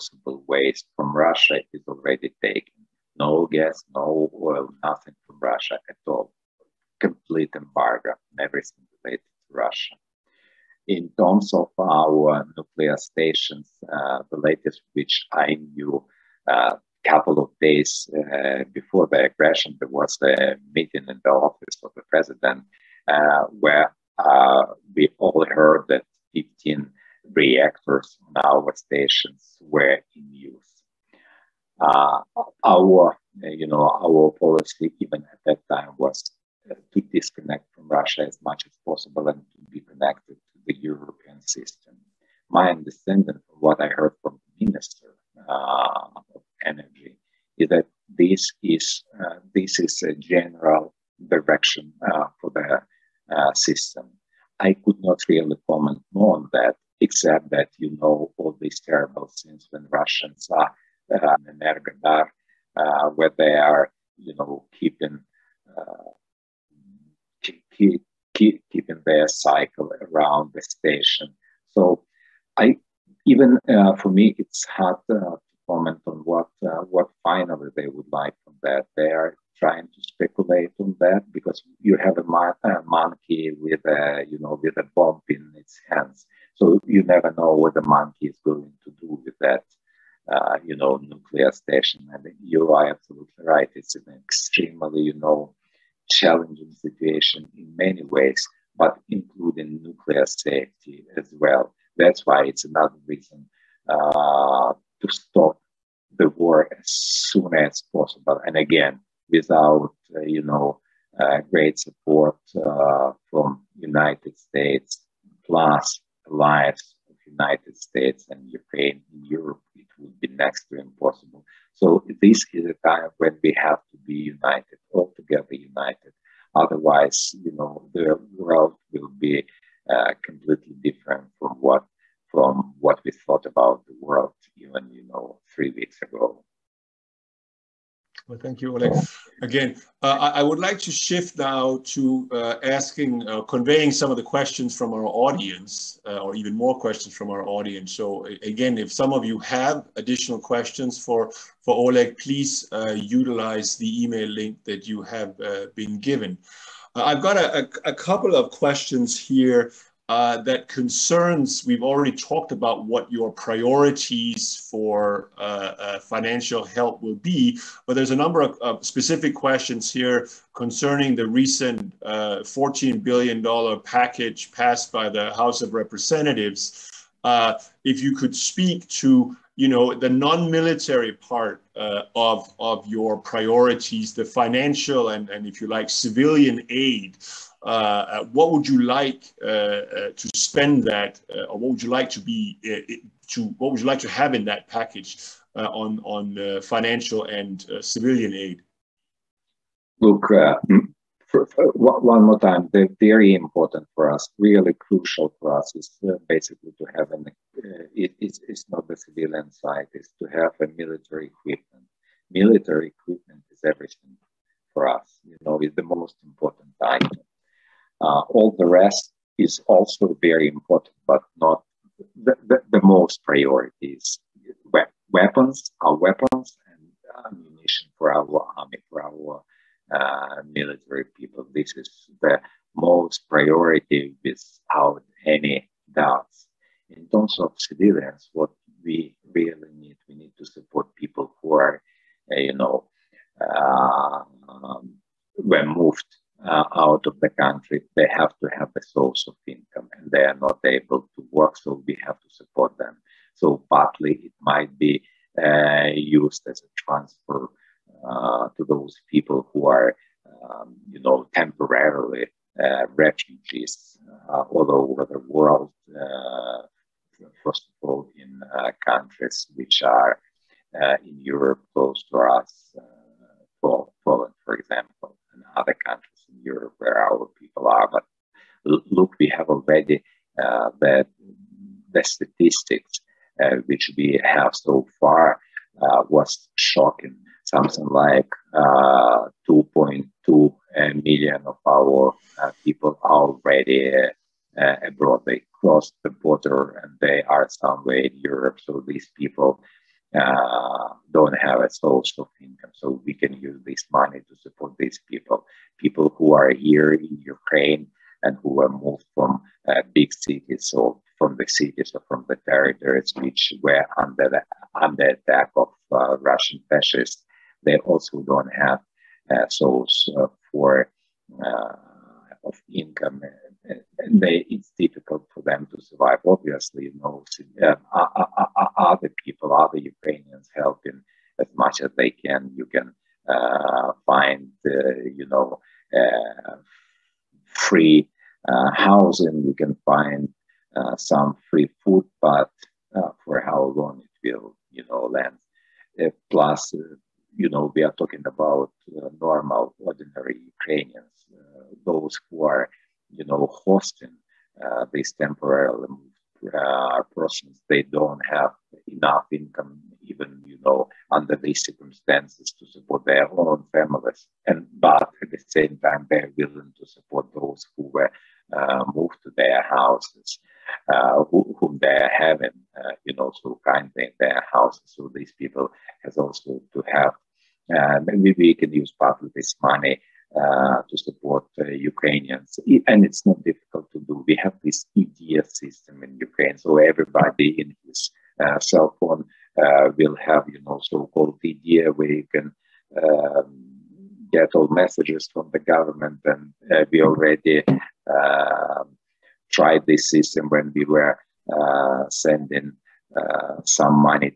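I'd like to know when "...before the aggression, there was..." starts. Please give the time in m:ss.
0:18.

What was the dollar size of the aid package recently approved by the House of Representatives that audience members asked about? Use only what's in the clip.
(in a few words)
$14 billion.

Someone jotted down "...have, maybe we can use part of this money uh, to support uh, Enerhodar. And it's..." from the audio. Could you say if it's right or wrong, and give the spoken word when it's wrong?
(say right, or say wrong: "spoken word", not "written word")
wrong: "Ukrainians", not "Enerhodar".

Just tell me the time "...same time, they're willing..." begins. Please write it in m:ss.
6:05.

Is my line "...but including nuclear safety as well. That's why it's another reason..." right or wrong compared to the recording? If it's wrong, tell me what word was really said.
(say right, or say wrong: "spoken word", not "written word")
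right.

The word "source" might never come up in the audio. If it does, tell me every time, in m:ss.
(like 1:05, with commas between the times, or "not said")
4:08, 5:01, 5:19.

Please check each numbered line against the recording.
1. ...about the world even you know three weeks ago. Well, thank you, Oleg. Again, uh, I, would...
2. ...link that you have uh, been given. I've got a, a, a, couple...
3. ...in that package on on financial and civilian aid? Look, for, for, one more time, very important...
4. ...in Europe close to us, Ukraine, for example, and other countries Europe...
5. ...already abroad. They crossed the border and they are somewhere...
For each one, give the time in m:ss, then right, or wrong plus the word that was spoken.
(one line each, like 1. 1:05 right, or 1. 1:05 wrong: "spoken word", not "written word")
1. 2:13 right
2. 2:34 right
3. 3:14 right
4. 4:31 wrong: "Poland", not "Ukraine"
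5. 4:53 right.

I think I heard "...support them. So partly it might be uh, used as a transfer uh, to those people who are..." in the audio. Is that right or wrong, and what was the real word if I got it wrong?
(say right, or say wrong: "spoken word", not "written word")
right.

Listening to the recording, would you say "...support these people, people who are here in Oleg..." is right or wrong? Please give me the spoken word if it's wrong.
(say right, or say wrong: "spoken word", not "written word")
wrong: "Ukraine", not "Oleg".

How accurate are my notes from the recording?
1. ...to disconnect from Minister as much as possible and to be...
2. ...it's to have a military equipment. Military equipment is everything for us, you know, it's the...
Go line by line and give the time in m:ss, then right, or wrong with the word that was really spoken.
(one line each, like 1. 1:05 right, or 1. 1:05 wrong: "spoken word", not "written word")
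1. 0:36 wrong: "Russia", not "Minister"
2. 3:29 right.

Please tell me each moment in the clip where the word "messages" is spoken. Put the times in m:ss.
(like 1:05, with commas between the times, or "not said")
6:34.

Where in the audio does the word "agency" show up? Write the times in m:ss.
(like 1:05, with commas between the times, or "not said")
not said.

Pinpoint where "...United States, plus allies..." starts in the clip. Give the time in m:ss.
1:53.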